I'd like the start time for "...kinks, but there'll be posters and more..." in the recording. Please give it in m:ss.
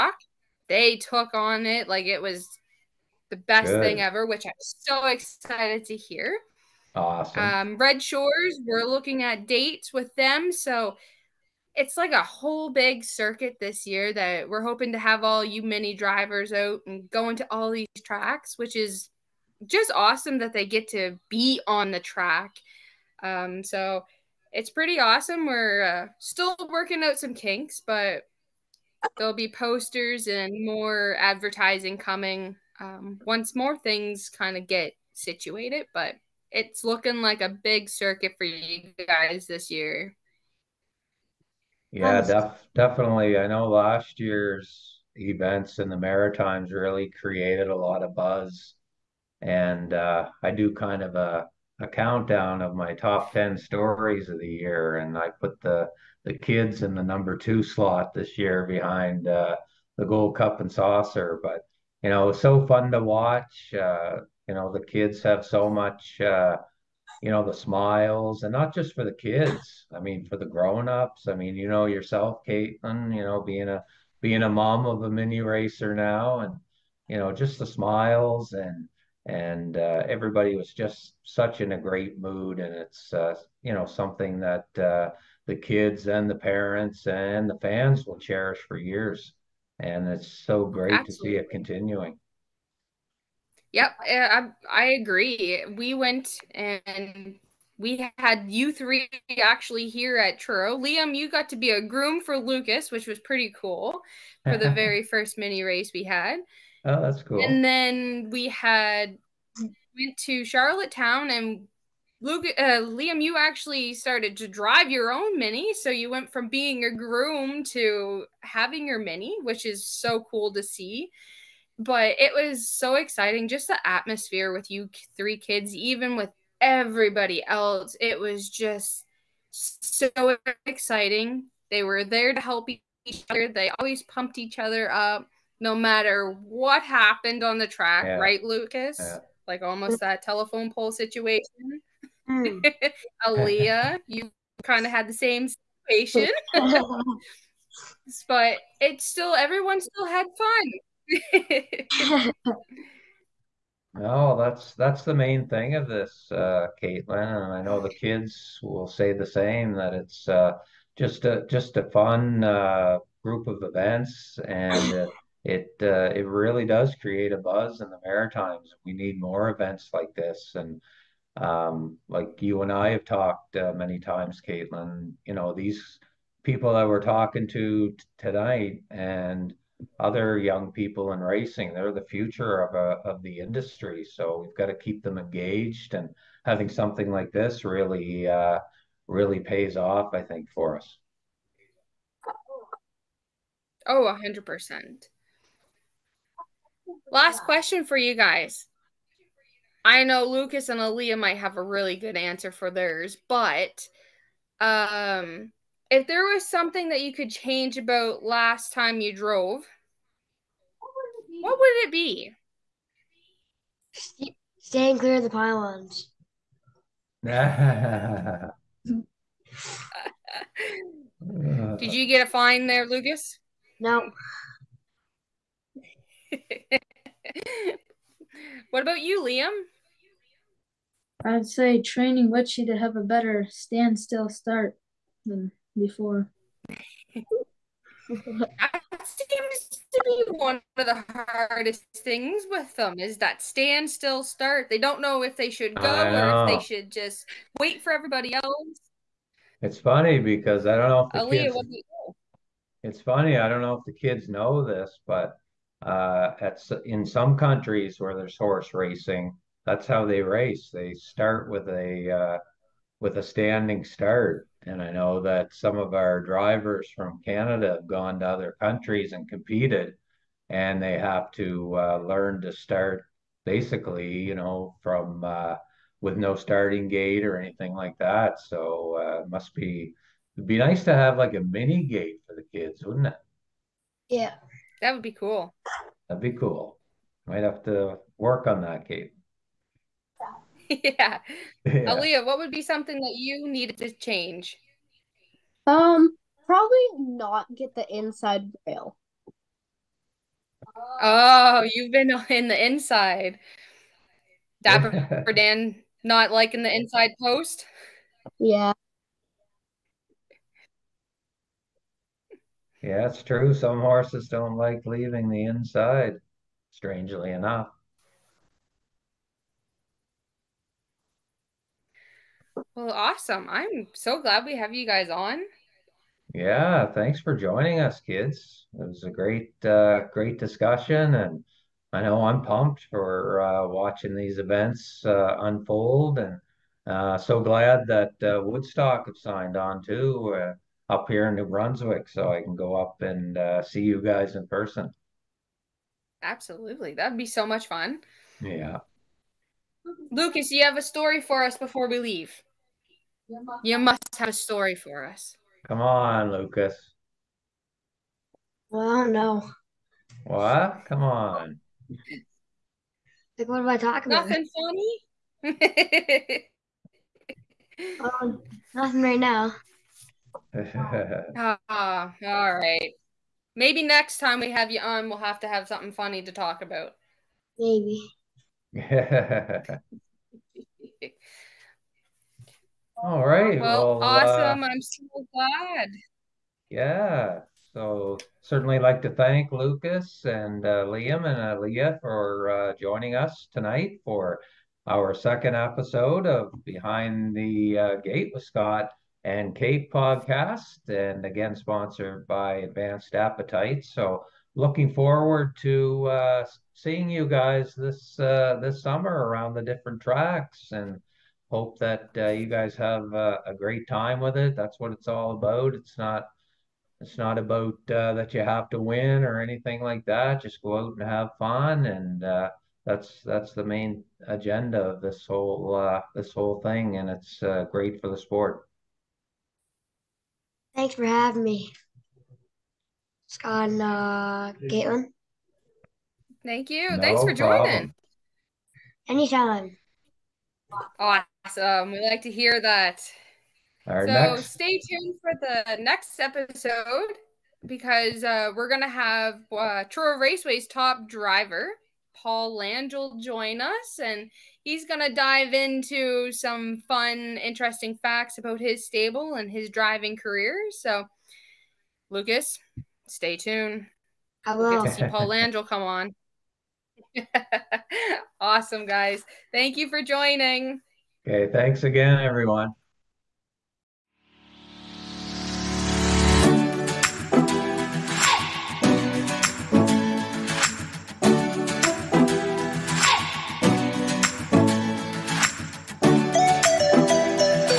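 0:27.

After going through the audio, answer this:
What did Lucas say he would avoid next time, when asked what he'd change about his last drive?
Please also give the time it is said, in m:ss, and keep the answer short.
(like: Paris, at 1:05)
The pylons, at 3:35.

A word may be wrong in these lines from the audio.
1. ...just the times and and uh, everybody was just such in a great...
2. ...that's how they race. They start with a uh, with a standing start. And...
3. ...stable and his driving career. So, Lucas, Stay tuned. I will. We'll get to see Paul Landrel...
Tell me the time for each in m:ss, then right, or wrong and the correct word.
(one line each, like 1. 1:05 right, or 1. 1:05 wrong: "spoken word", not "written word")
1. 1:17 wrong: "smiles", not "times"
2. 4:19 right
3. 7:38 right.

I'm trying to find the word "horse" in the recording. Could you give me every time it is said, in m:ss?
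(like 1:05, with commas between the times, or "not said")
4:18, 5:13.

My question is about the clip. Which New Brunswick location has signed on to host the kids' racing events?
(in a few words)
Woodstock.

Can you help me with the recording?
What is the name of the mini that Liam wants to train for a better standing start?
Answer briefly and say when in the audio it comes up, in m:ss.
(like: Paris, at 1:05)
Witchy, at 3:52.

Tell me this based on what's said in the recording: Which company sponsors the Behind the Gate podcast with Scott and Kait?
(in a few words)
Advanced Appetite.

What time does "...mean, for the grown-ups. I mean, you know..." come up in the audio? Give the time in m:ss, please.
1:10.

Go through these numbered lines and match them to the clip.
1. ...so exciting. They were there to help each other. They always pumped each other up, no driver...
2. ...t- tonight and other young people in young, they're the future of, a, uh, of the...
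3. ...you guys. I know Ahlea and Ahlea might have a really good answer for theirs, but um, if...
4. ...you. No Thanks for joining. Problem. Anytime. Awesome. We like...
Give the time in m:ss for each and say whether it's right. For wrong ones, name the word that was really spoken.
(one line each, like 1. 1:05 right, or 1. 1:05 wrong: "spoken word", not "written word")
1. 2:09 wrong: "matter", not "driver"
2. 2:57 wrong: "racing", not "young"
3. 3:17 wrong: "Lucas", not "Ahlea"
4. 7:16 right.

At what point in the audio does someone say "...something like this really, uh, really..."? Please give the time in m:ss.
3:06.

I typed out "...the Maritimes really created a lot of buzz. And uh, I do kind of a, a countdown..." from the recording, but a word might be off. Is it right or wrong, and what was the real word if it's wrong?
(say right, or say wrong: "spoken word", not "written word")
right.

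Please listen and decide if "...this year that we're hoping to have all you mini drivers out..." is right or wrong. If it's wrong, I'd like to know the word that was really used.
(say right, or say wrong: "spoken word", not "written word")
right.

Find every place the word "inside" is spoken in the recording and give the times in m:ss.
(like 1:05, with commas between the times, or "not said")
4:57, 5:02, 5:06, 5:15.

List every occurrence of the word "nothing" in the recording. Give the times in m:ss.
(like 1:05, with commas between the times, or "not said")
6:04, 6:08.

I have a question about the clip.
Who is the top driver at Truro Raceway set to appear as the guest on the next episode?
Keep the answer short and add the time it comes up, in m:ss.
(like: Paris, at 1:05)
Paul Langille, at 7:32.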